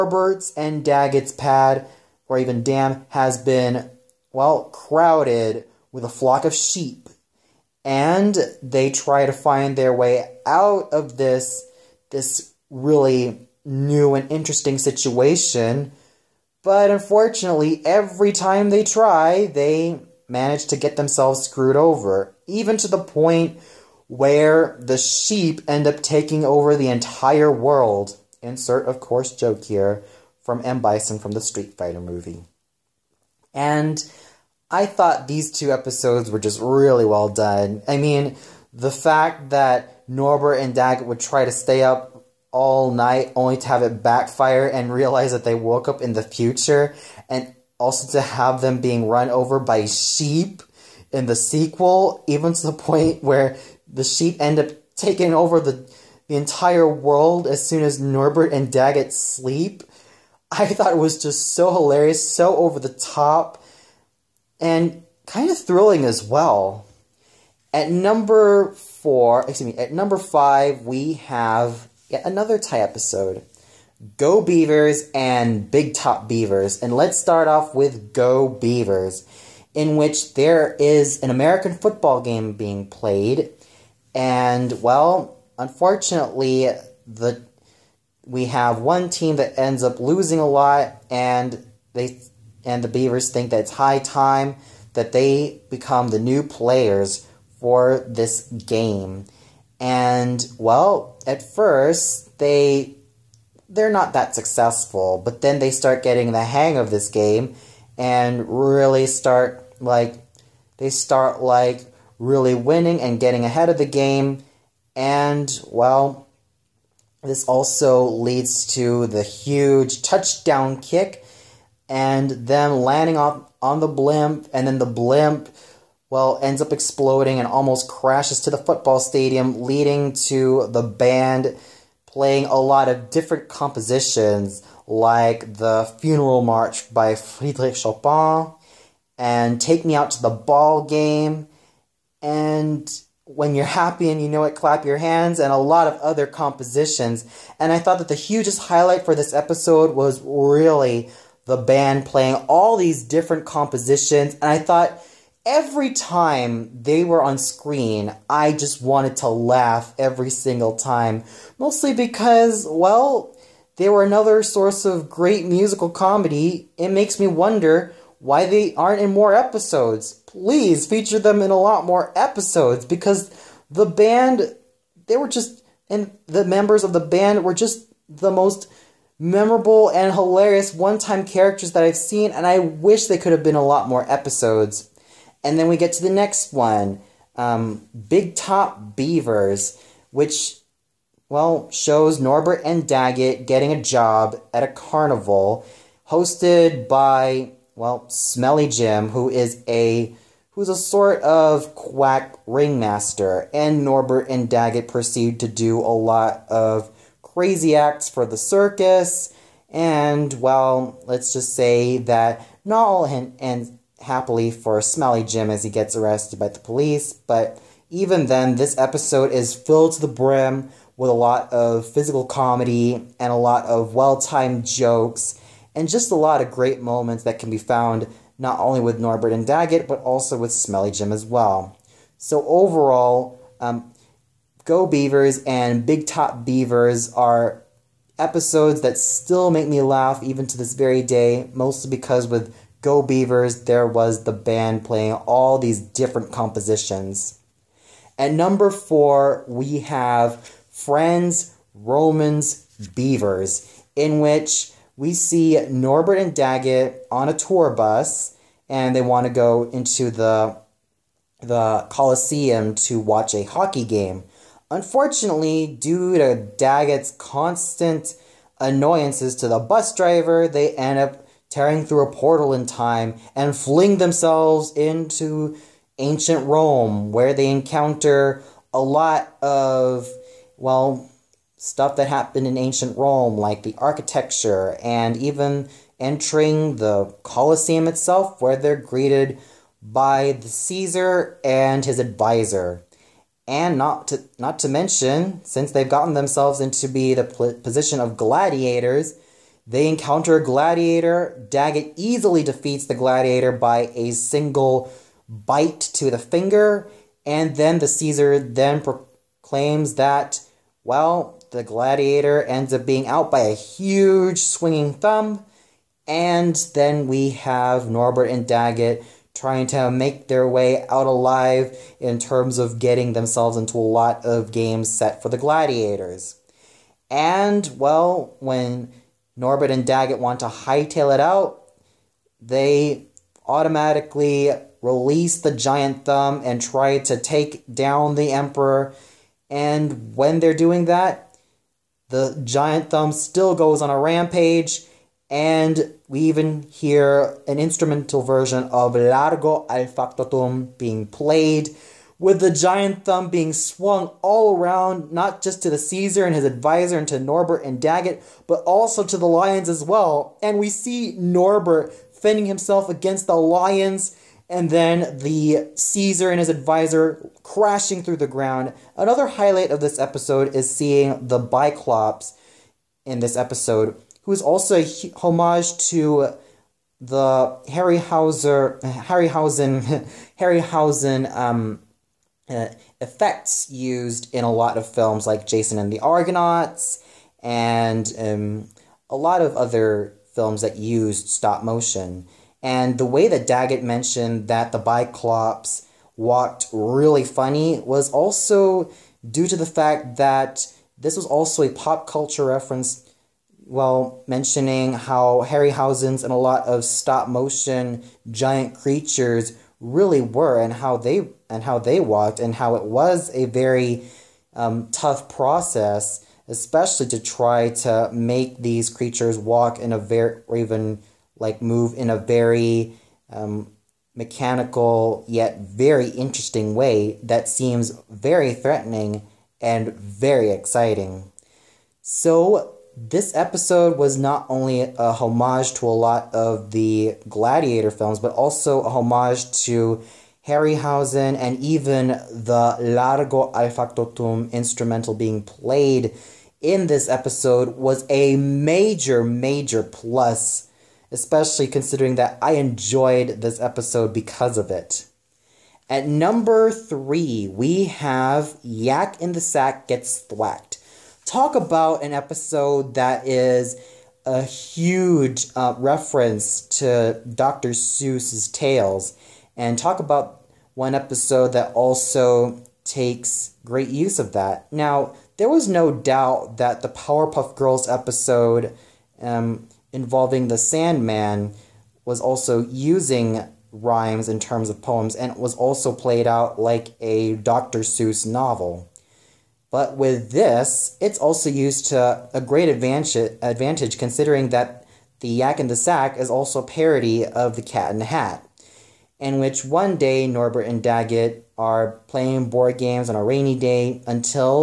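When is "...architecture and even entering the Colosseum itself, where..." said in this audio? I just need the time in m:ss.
4:43.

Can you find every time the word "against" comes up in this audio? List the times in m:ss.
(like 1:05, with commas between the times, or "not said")
6:02.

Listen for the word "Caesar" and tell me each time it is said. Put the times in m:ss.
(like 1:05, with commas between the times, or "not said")
4:50, 5:07, 5:55, 6:05.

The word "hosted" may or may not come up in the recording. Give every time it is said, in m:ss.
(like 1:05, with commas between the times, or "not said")
3:16.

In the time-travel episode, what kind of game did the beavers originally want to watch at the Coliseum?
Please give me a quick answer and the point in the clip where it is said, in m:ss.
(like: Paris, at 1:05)
hockey game, at 4:23.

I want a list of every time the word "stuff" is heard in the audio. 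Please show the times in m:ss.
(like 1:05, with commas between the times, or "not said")
4:41.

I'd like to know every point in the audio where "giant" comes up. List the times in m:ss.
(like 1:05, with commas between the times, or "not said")
5:35, 5:42, 5:52, 6:48.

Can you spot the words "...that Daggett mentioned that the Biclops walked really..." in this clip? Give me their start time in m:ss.
6:33.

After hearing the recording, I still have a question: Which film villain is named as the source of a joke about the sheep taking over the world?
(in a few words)
M. Bison.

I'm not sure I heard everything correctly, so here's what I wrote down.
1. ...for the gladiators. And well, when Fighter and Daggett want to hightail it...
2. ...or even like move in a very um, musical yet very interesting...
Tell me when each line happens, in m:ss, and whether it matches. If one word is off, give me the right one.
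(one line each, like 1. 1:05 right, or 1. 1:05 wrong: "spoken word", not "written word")
1. 5:25 wrong: "Norbert", not "Fighter"
2. 7:00 wrong: "mechanical", not "musical".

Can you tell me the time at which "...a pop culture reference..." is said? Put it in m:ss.
6:41.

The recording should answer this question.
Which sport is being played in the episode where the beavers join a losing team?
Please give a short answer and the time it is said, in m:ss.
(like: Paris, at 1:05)
American football, at 1:21.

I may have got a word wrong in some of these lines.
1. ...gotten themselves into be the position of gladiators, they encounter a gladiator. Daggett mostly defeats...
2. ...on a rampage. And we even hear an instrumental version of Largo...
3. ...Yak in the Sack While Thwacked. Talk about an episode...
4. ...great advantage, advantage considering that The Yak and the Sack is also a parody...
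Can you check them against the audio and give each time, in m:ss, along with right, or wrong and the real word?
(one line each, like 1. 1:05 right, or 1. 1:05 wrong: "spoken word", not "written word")
1. 4:55 wrong: "easily", not "mostly"
2. 5:43 right
3. 7:38 wrong: "Gets", not "While"
4. 8:12 right.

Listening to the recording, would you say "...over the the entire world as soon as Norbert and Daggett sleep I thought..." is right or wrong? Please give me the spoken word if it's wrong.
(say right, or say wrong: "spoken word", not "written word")
right.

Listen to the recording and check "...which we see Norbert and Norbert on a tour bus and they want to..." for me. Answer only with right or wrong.
wrong.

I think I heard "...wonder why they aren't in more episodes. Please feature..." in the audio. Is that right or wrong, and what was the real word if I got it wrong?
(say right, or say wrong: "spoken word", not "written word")
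right.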